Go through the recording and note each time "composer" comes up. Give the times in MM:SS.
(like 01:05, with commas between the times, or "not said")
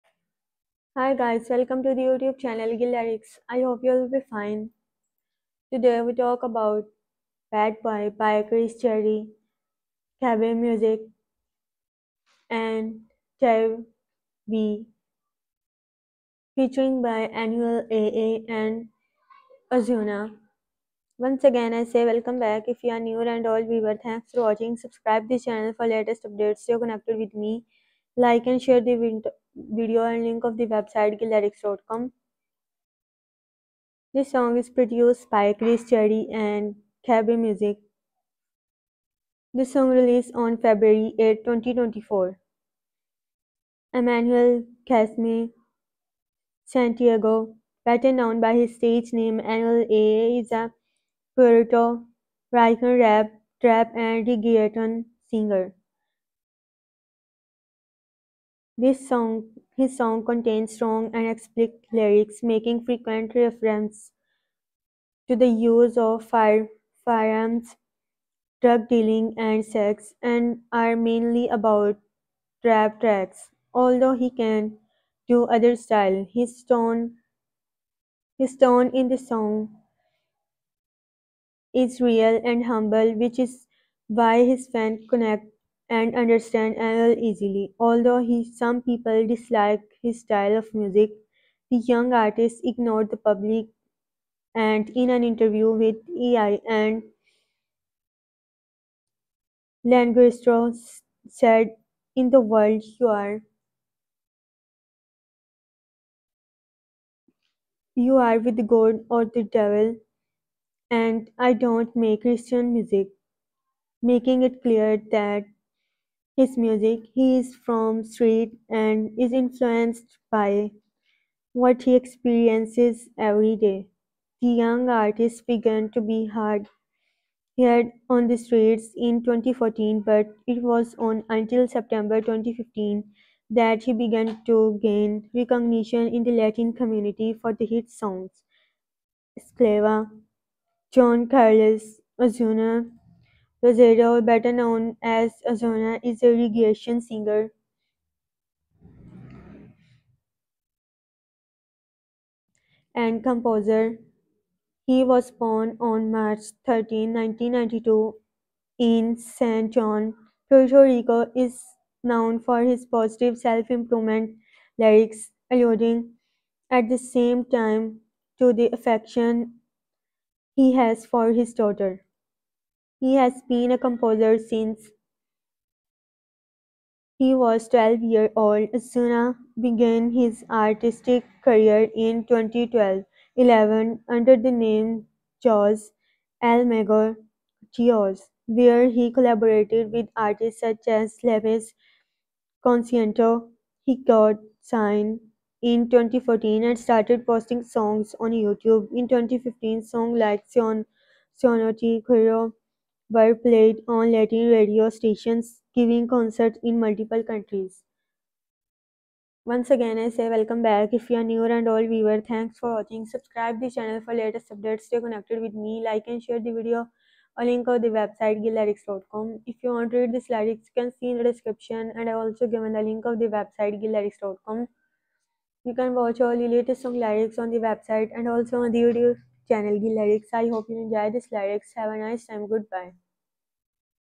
02:33, 02:53.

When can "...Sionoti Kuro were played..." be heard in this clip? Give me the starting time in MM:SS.
03:21.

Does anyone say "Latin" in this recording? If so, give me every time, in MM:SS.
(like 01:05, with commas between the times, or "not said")
02:16, 03:24.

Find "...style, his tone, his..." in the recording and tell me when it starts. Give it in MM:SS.
01:15.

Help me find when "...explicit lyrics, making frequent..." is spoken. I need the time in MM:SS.
01:01.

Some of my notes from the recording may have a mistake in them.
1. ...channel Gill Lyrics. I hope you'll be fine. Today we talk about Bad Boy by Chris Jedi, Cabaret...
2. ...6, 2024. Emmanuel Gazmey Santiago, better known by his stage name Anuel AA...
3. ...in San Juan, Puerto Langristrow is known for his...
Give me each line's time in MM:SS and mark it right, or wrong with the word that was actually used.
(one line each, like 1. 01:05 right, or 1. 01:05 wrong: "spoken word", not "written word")
1. 00:02 right
2. 00:41 wrong: "8", not "6"
3. 02:38 wrong: "Rico", not "Langristrow".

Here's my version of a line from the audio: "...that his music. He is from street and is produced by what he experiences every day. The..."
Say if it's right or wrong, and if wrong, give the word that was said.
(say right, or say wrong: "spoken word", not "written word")
wrong: "influenced", not "produced".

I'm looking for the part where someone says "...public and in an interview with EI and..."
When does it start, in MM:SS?
01:33.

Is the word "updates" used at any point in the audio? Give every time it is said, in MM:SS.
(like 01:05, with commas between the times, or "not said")
00:26, 03:34.